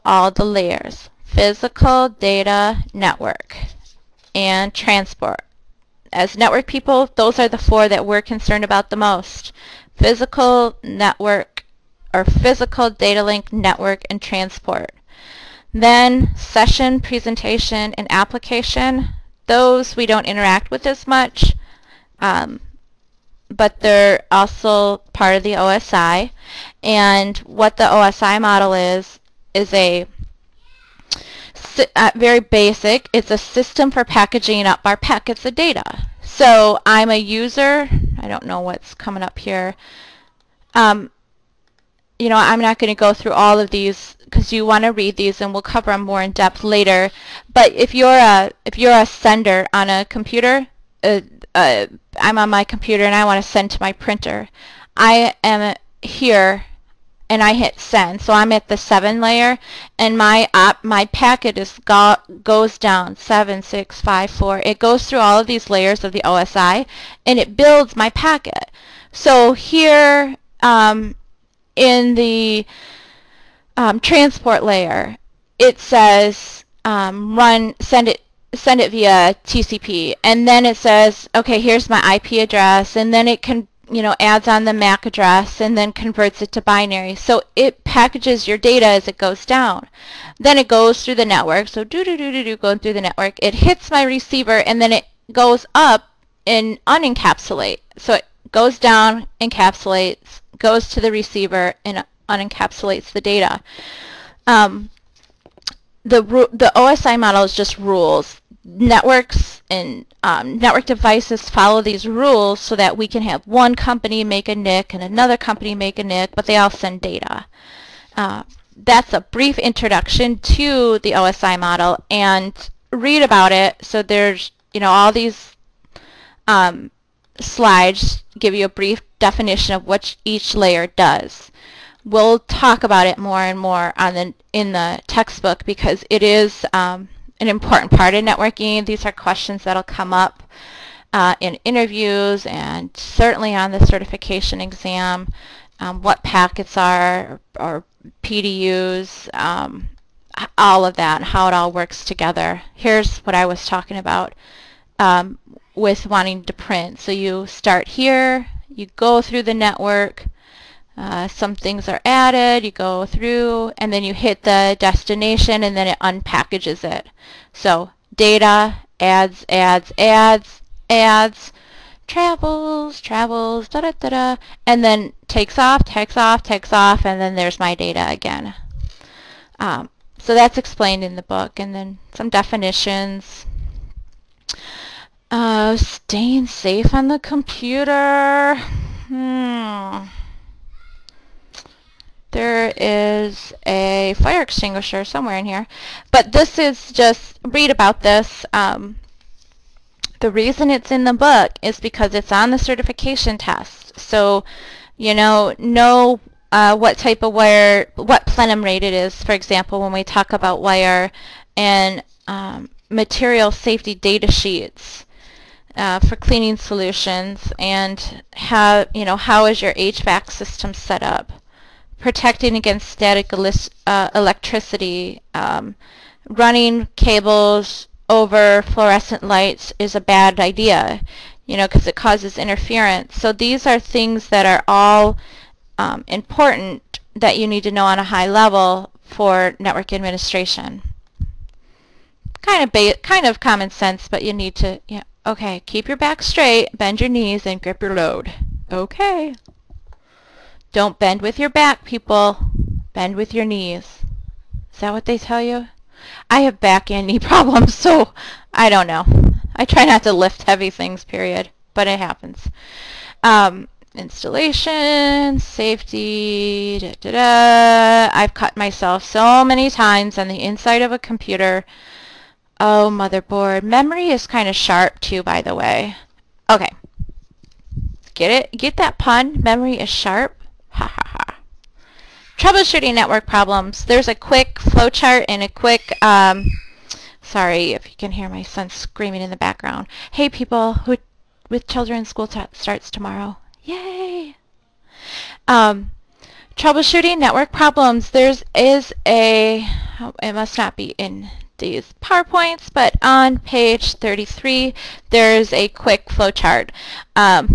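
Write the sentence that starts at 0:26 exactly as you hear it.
And what the OSI model is, is a at very basic, it's a system for packaging up our packets of data.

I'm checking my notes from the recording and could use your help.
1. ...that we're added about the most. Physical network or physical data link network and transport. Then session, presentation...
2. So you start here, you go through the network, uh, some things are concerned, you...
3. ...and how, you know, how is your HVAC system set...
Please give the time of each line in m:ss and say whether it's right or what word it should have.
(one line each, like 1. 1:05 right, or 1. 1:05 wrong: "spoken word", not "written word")
1. 0:07 wrong: "concerned", not "added"
2. 2:36 wrong: "added", not "concerned"
3. 3:37 right.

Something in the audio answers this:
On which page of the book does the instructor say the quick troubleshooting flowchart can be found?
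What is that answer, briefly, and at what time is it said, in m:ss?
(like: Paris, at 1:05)
33, at 5:03.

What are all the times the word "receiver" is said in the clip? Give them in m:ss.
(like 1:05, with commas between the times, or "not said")
1:34, 1:41.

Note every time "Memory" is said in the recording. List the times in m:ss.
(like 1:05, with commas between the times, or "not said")
4:33, 4:39.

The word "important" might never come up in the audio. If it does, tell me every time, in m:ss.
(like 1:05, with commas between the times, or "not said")
2:17, 3:56.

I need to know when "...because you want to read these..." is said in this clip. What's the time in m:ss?
0:44.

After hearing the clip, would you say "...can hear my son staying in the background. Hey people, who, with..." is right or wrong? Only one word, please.
wrong.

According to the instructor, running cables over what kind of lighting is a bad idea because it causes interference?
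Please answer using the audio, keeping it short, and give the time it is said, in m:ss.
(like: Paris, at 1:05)
Fluorescent lights, at 3:48.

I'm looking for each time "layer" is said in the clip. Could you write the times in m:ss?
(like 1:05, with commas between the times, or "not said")
0:00, 0:59, 1:05, 1:14, 2:10.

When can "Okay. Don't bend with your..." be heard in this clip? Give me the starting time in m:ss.
4:08.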